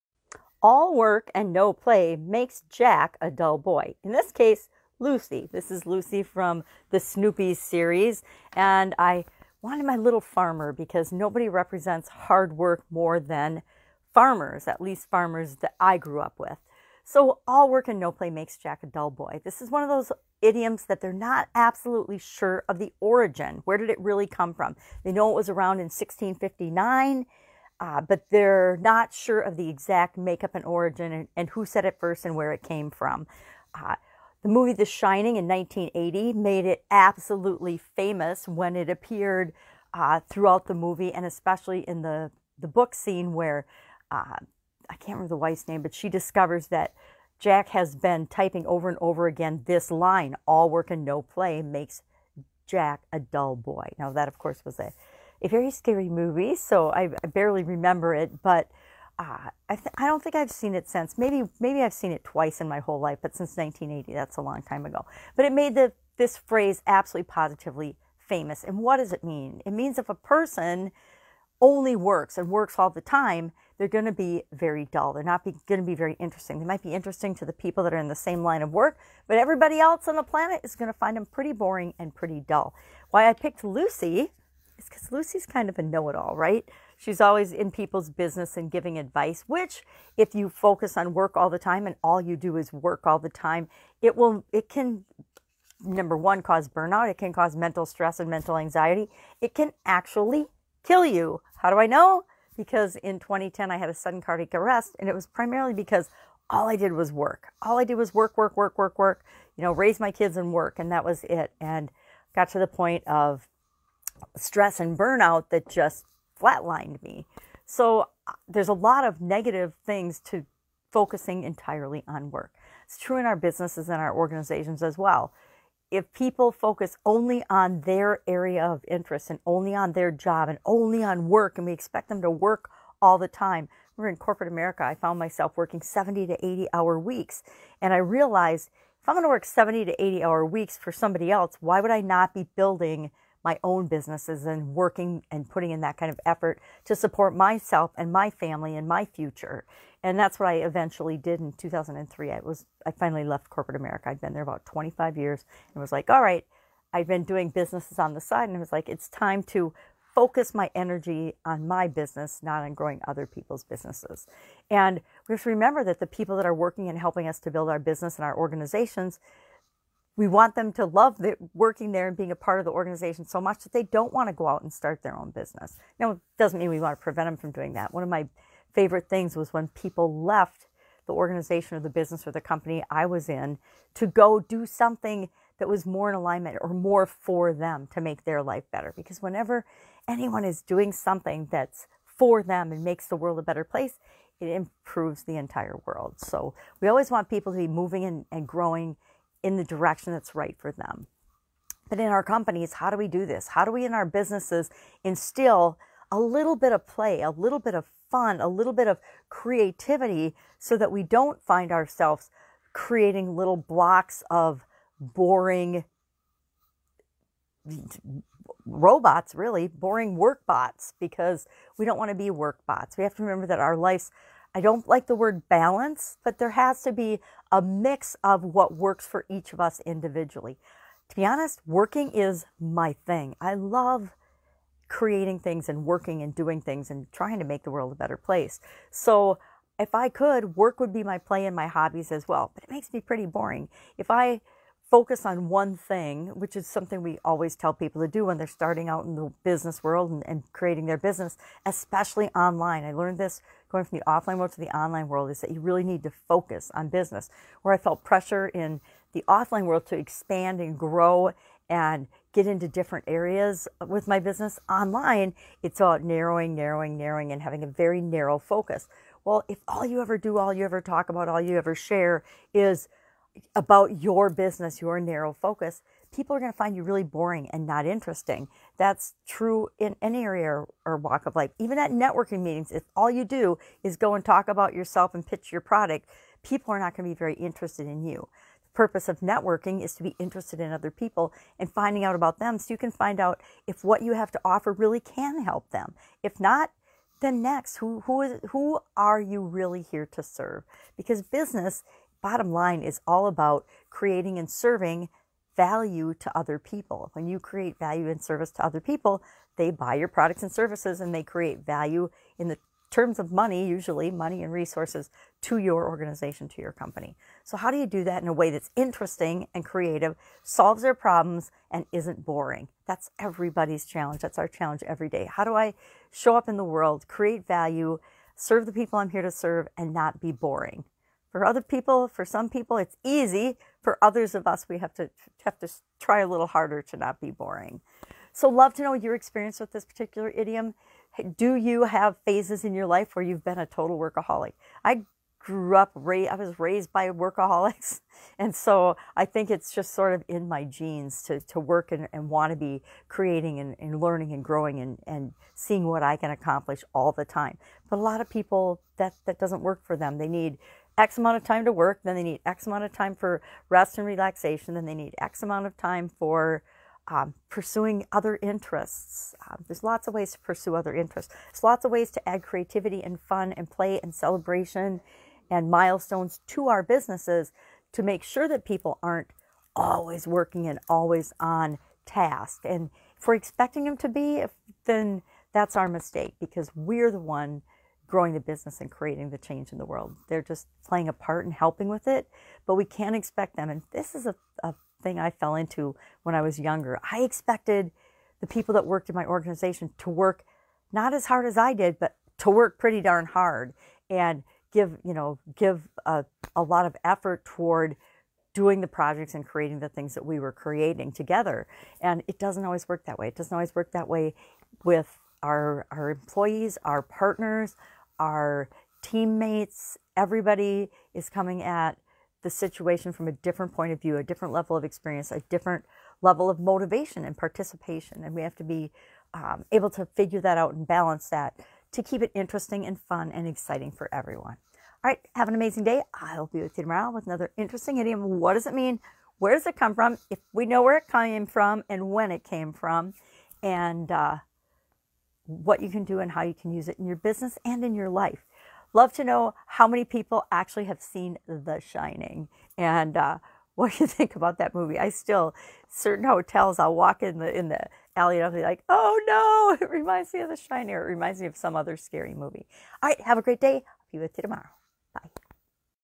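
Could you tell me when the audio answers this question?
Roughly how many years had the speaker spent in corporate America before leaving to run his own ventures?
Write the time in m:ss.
2:34.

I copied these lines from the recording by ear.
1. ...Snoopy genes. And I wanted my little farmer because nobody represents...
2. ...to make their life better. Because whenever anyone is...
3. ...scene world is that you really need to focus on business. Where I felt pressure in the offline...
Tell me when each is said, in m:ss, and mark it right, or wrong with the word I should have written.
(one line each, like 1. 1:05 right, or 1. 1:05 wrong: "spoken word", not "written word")
1. 0:06 wrong: "series", not "genes"
2. 3:07 right
3. 4:14 wrong: "online", not "scene".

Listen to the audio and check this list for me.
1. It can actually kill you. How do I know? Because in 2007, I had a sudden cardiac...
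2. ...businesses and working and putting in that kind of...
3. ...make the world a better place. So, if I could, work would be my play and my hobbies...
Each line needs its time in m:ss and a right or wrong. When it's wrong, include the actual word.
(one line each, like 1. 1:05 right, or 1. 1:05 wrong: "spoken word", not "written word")
1. 1:39 wrong: "2010", not "2007"
2. 2:23 right
3. 3:57 right.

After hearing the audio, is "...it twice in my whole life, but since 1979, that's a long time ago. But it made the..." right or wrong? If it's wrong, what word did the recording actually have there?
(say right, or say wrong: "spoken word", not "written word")
wrong: "1980", not "1979".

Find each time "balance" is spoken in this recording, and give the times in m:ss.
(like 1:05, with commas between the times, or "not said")
3:45, 7:10.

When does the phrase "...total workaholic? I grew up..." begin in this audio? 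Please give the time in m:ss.
5:43.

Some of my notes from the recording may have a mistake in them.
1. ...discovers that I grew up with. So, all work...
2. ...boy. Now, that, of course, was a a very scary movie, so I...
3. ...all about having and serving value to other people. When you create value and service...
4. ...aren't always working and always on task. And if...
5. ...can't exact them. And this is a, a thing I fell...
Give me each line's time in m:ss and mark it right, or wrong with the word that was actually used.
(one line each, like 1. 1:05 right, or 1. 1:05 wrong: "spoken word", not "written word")
1. 0:15 wrong: "farmers", not "discovers"
2. 0:53 right
3. 5:03 wrong: "creating", not "having"
4. 6:19 right
5. 6:32 wrong: "expect", not "exact".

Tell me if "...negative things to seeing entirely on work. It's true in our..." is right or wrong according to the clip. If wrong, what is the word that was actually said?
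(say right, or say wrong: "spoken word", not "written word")
wrong: "focusing", not "seeing".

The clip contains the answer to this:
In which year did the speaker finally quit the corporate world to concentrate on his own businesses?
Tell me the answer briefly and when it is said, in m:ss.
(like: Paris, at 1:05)
2003, at 2:31.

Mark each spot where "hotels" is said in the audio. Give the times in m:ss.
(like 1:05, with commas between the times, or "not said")
7:36.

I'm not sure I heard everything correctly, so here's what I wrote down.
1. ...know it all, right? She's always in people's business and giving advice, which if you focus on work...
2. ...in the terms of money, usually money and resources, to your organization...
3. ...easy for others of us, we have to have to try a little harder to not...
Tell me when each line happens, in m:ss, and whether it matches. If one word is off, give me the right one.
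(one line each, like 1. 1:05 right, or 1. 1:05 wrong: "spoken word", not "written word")
1. 1:25 right
2. 5:12 right
3. 5:33 right.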